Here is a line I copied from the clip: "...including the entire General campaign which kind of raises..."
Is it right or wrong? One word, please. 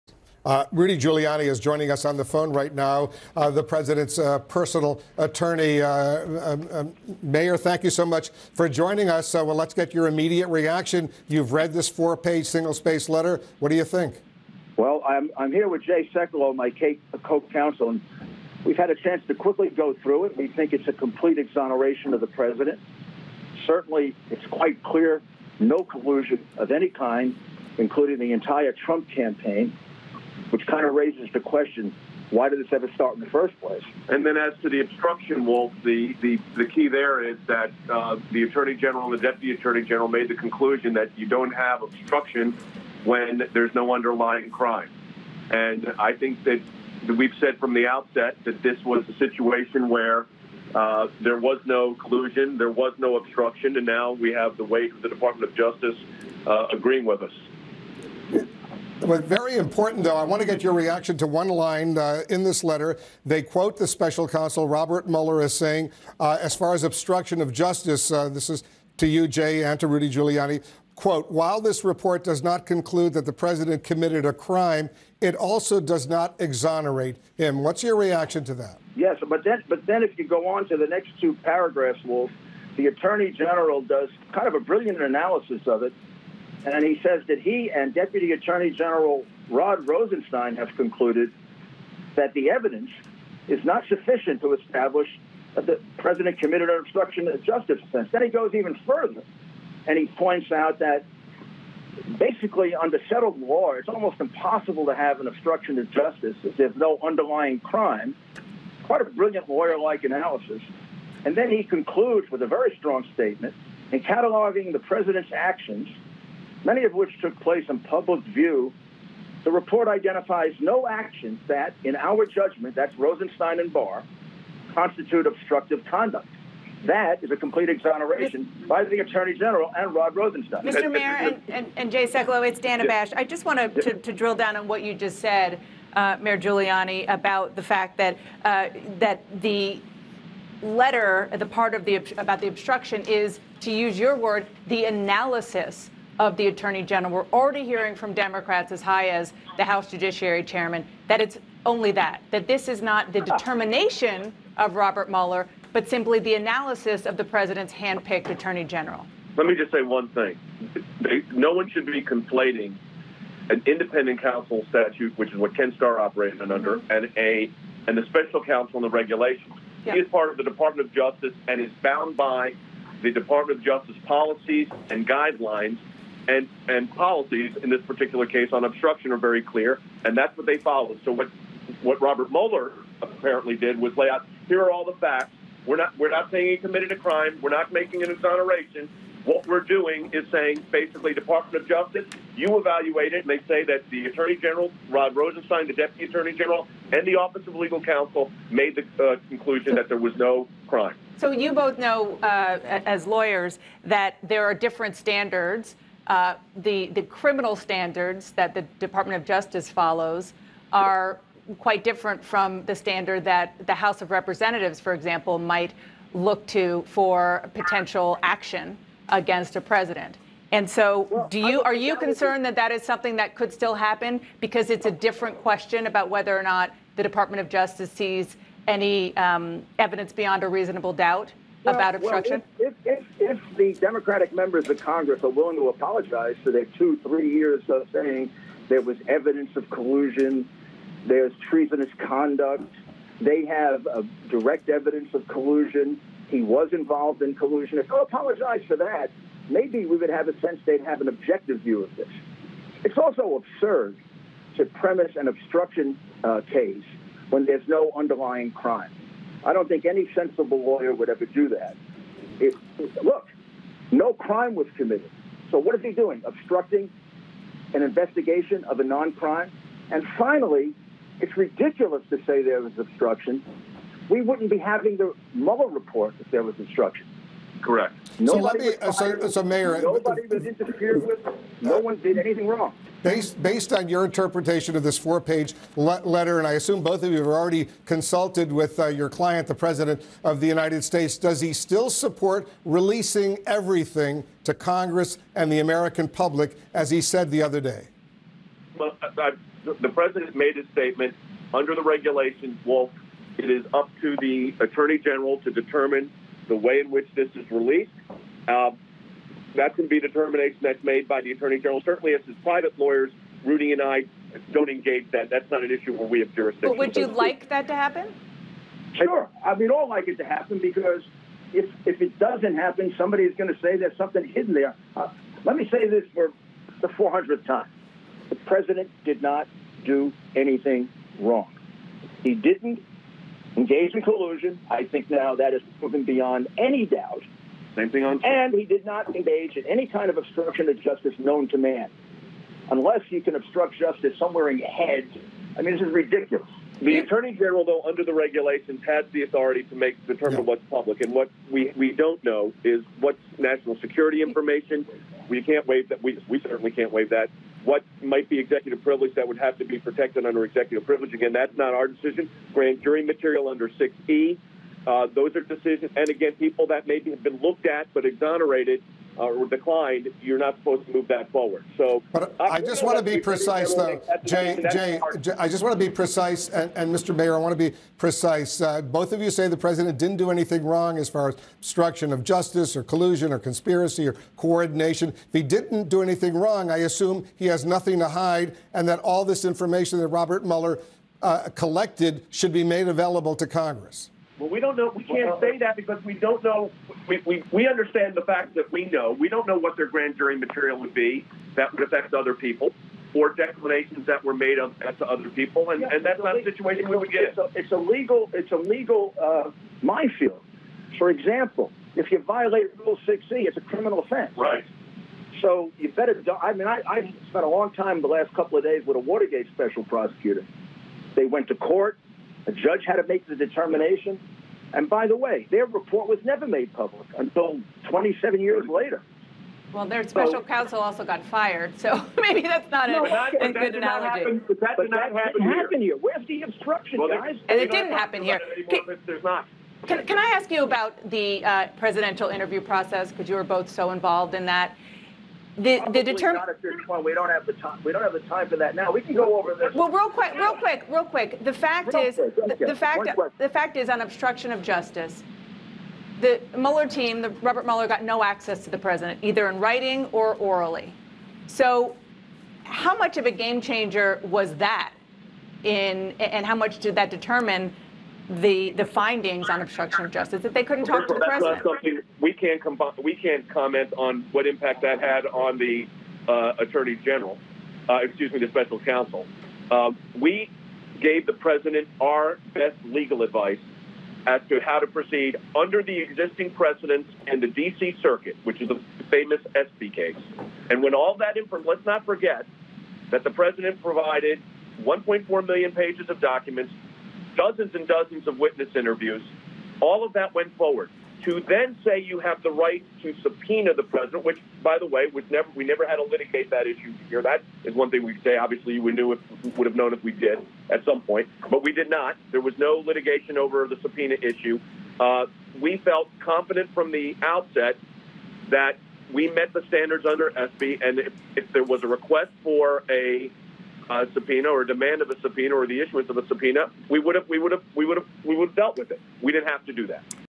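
wrong.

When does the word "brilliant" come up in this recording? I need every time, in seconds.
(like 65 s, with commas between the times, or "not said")
84 s, 109 s.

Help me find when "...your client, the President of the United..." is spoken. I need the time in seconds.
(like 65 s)
288 s.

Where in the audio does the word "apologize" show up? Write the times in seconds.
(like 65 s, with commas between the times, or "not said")
235 s, 247 s.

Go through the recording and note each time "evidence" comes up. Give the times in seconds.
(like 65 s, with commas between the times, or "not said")
92 s, 229 s, 239 s, 244 s.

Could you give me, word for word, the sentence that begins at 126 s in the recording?
That is a complete exoneration Mr.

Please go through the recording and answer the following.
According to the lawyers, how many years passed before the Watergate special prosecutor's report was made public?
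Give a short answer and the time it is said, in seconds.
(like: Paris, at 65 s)
27, at 427 s.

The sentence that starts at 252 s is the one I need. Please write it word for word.
It's also absurd to premise an obstruction uh, case when there's no underlying crime.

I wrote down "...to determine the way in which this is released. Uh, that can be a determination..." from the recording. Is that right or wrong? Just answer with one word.
right.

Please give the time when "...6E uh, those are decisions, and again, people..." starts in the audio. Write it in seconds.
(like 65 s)
363 s.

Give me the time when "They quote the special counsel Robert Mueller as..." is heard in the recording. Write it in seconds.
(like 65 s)
63 s.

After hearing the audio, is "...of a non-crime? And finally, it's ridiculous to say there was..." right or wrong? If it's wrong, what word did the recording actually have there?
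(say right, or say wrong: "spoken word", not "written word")
right.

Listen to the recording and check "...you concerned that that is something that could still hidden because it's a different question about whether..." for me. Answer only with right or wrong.
wrong.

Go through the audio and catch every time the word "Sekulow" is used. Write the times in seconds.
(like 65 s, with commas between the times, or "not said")
16 s, 132 s.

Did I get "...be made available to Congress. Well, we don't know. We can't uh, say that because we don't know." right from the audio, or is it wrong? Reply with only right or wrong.
right.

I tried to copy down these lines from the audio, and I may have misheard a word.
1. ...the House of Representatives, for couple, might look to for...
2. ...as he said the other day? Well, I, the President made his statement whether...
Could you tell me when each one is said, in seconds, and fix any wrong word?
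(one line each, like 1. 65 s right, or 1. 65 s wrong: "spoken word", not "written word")
1. 213 s wrong: "example", not "couple"
2. 296 s wrong: "under", not "whether".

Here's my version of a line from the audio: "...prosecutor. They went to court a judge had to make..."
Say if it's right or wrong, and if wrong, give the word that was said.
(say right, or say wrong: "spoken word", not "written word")
right.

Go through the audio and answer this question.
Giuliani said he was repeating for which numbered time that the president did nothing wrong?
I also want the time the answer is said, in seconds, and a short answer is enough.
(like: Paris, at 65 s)
400th, at 326 s.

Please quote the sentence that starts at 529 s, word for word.
We didn't have to do that.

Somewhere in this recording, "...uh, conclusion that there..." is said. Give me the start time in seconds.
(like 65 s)
199 s.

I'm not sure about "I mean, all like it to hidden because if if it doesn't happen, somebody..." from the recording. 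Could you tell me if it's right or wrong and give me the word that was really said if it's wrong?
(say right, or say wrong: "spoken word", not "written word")
wrong: "happen", not "hidden".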